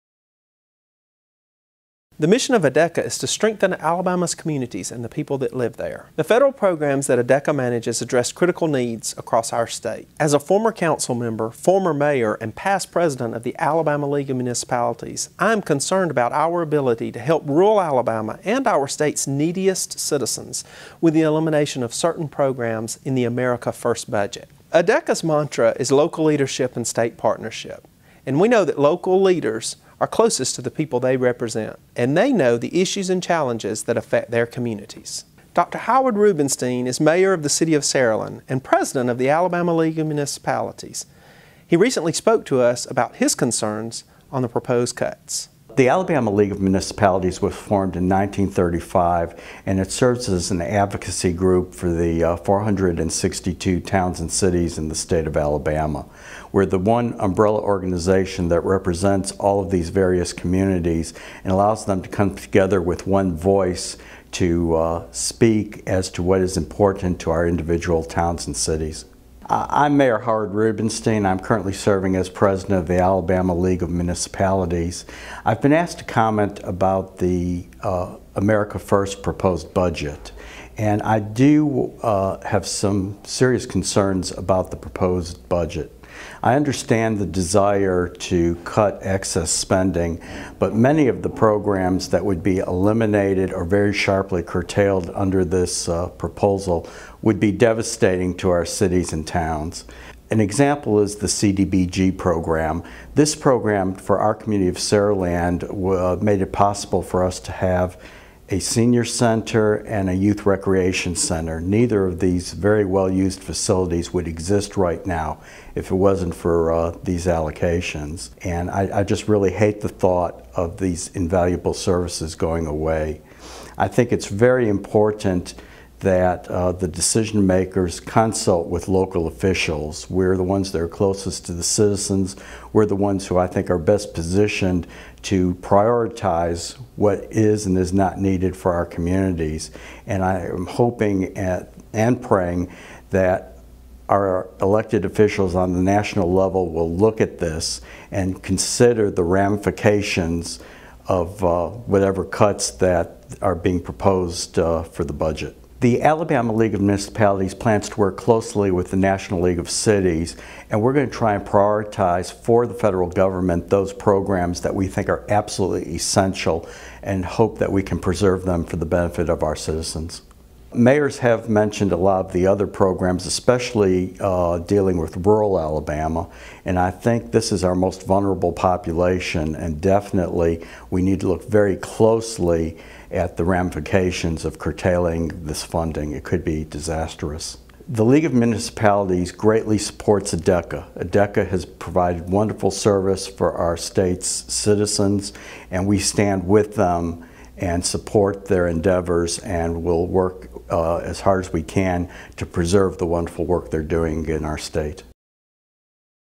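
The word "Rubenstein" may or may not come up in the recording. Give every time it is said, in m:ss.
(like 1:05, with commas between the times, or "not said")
0:36, 1:10.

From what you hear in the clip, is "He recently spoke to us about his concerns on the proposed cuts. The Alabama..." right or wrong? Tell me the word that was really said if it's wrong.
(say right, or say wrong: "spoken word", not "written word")
right.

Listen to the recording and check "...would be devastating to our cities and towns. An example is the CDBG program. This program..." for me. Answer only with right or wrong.
right.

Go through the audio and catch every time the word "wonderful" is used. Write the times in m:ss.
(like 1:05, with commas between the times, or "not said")
3:12, 3:23.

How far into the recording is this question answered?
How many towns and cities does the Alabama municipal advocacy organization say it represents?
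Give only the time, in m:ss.
0:52.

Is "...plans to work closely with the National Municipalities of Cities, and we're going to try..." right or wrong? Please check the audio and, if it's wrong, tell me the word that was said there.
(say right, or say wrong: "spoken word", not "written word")
wrong: "League", not "Municipalities".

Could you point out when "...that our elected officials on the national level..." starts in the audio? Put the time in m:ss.
2:23.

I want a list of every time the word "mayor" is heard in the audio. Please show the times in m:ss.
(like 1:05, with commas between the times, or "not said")
0:11, 0:36, 1:09, 2:50.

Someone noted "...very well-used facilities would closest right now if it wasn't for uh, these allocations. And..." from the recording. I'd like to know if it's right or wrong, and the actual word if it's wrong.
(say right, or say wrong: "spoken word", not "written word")
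wrong: "exist", not "closest".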